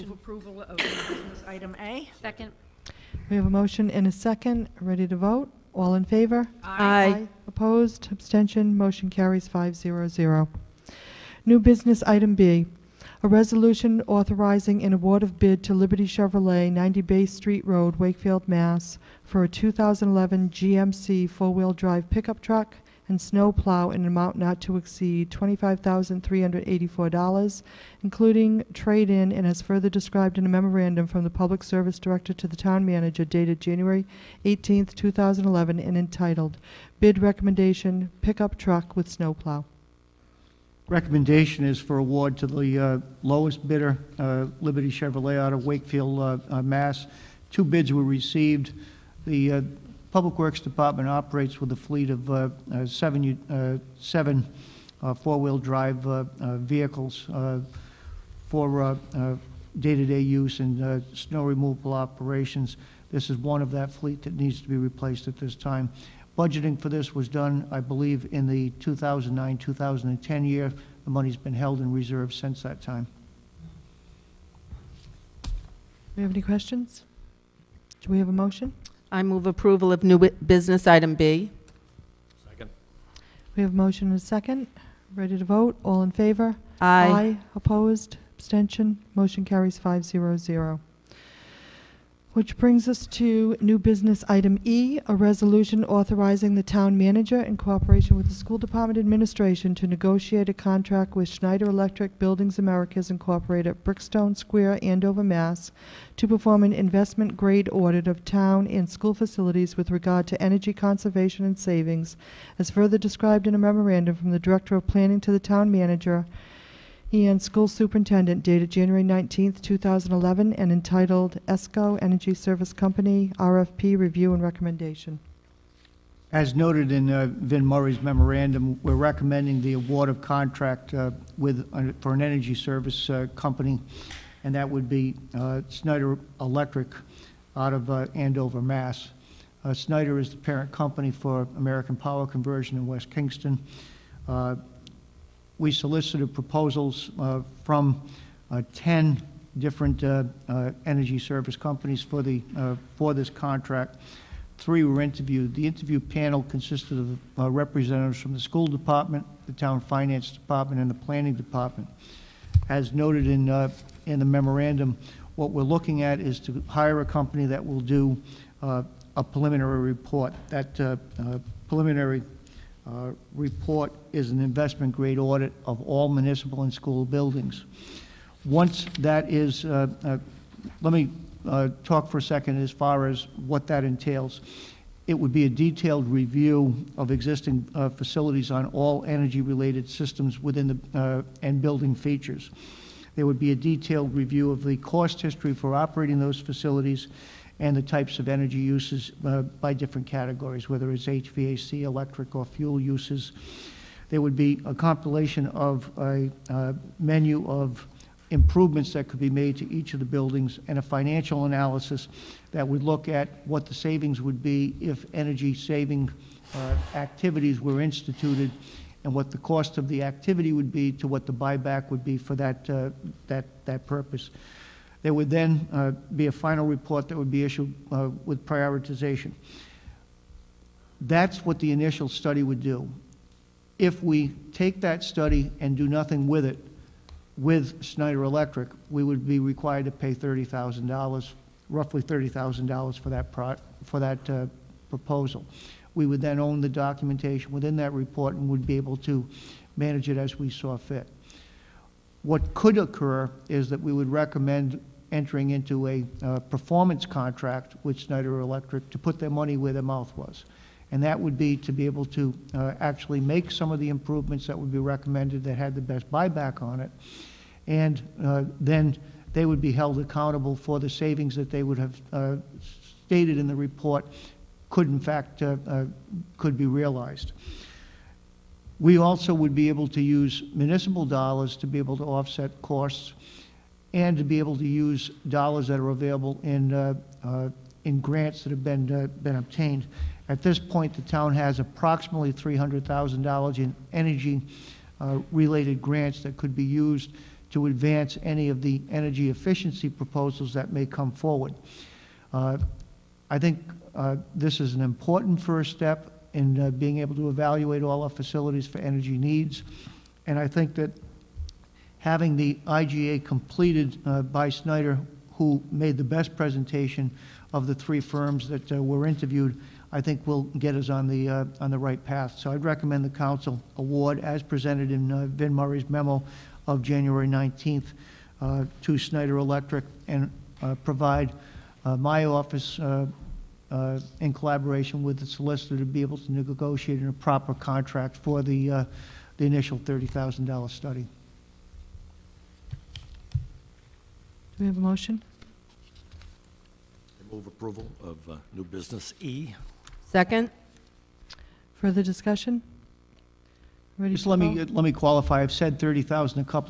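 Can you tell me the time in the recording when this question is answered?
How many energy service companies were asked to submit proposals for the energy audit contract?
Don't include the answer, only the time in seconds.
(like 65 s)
148 s.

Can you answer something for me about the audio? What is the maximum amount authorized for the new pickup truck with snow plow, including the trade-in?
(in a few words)
$25,384.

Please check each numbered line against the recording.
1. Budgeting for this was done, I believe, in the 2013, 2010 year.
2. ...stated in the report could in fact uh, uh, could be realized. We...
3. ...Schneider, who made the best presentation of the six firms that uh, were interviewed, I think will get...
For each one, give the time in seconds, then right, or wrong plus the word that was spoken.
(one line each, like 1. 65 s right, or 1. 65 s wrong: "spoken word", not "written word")
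1. 66 s wrong: "2009", not "2013"
2. 273 s right
3. 314 s wrong: "three", not "six".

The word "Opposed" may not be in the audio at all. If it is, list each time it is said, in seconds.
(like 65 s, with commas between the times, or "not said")
7 s, 87 s.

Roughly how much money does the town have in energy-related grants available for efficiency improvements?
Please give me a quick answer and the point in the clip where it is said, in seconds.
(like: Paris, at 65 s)
$300,000, at 292 s.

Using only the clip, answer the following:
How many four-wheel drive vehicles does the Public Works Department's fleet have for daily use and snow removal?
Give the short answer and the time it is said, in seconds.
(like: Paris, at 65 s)
7, at 53 s.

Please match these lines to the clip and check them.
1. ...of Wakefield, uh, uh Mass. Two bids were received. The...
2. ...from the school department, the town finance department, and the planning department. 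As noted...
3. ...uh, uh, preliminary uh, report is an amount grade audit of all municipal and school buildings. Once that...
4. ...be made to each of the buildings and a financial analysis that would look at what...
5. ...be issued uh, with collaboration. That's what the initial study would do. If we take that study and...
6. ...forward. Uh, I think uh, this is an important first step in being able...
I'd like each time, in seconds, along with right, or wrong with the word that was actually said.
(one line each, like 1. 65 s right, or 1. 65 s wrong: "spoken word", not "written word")
1. 45 s right
2. 158 s right
3. 170 s wrong: "investment", not "amount"
4. 209 s right
5. 227 s wrong: "prioritization", not "collaboration"
6. 301 s right.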